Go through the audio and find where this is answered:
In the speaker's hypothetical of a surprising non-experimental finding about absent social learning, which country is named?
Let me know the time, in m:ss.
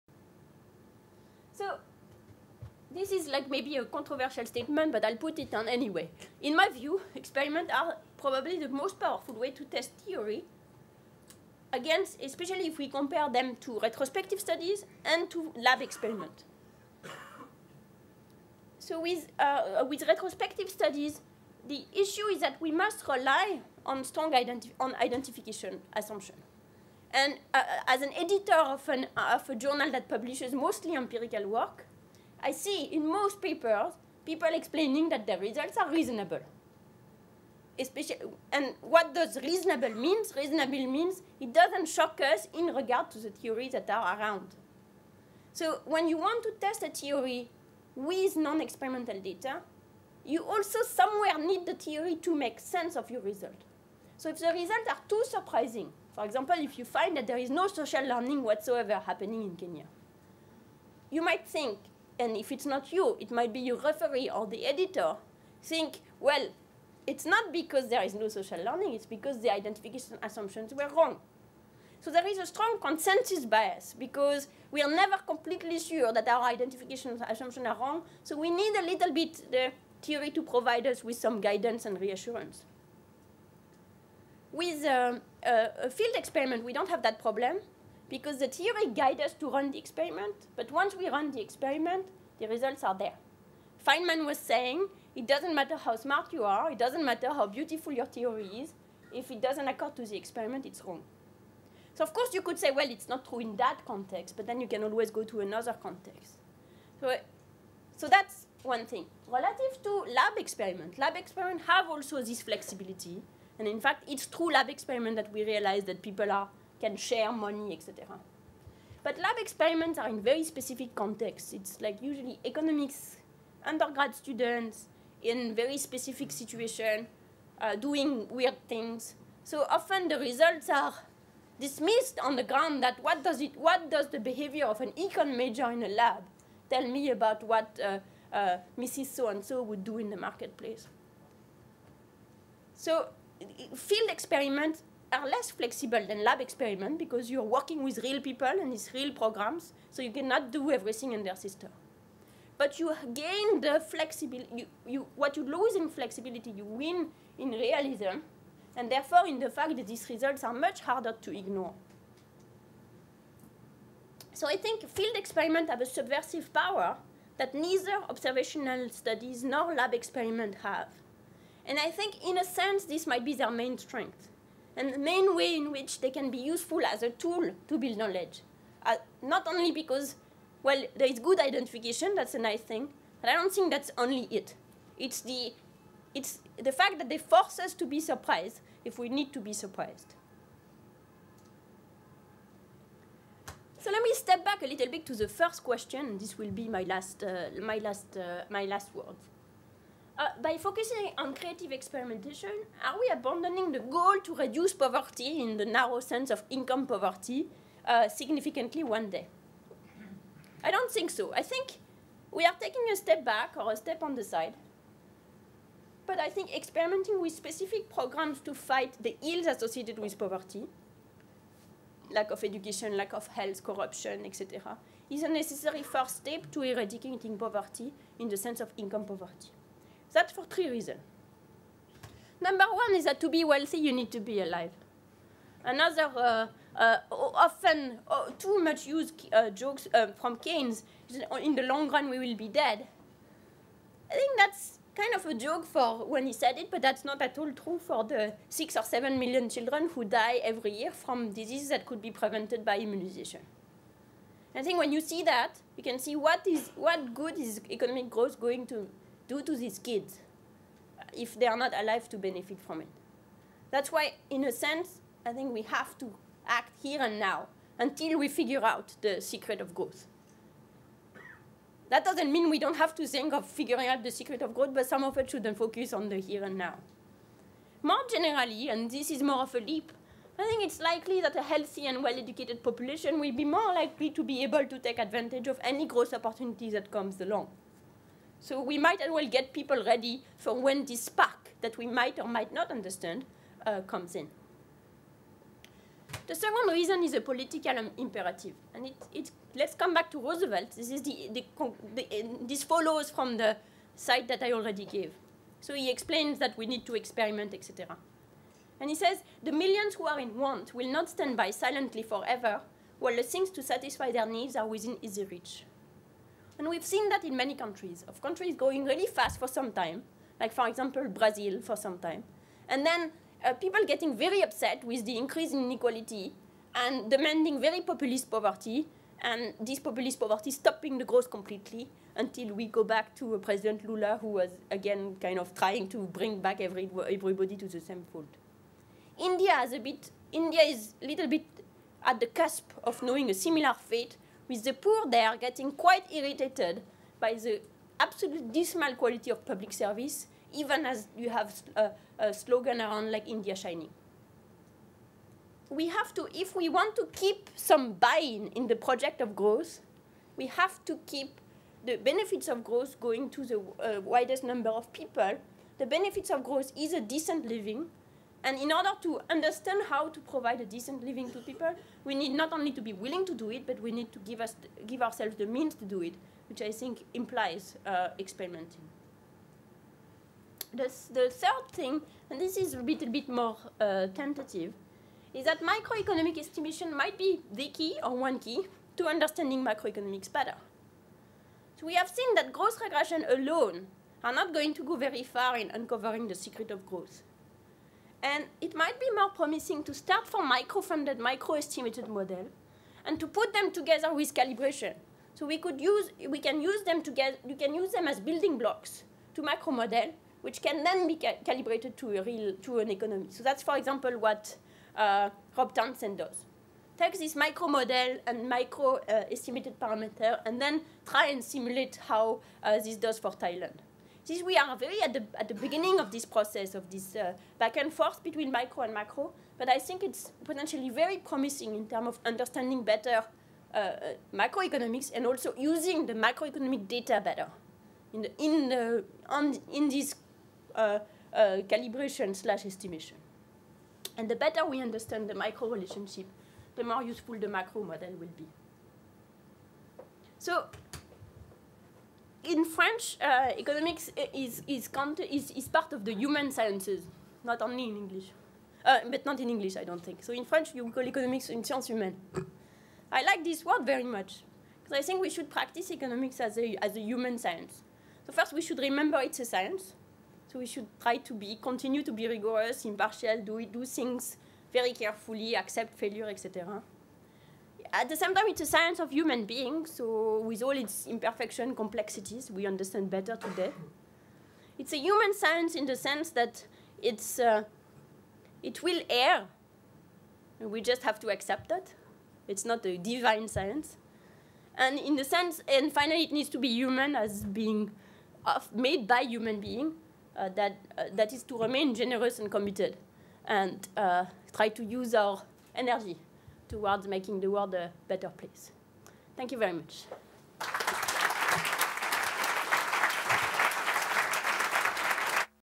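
0:59.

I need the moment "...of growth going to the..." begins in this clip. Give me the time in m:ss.
6:02.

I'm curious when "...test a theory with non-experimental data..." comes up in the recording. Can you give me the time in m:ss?
0:46.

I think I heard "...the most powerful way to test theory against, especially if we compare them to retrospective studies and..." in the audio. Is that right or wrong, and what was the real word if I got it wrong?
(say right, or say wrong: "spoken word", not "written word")
right.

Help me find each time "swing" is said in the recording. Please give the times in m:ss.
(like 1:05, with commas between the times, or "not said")
not said.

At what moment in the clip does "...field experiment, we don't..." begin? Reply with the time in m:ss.
1:25.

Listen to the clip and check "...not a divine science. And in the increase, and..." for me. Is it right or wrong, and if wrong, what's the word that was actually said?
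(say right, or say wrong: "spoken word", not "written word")
wrong: "sense", not "increase".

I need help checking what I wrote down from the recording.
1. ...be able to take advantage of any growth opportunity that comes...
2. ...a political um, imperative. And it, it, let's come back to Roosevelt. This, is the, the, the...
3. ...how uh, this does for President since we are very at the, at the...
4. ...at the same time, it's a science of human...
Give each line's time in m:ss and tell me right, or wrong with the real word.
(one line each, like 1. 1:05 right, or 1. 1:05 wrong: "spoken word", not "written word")
1. 4:44 right
2. 4:57 right
3. 7:02 wrong: "Thailand", not "President"
4. 7:57 right.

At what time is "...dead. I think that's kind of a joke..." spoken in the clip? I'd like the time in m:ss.
4:02.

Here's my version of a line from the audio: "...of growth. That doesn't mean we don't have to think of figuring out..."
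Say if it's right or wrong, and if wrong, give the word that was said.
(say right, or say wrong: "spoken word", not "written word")
right.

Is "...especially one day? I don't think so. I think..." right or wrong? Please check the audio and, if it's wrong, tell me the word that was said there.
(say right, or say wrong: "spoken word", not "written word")
wrong: "significantly", not "especially".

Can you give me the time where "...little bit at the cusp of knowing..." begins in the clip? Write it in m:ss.
5:41.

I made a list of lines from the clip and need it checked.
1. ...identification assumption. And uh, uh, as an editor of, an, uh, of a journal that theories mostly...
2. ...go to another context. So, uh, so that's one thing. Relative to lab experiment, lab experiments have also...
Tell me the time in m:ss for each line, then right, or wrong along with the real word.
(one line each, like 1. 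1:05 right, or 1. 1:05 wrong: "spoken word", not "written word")
1. 0:24 wrong: "publishes", not "theories"
2. 1:45 right.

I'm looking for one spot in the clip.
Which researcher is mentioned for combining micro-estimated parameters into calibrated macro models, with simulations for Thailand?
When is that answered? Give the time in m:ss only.
6:55.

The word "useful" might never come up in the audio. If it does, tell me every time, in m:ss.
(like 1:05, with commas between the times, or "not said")
2:56, 7:27.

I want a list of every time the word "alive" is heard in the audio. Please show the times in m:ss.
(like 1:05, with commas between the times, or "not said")
3:54, 4:21.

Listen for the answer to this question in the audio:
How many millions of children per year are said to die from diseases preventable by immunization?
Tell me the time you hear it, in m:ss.
4:08.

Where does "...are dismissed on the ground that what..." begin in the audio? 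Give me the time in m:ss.
2:10.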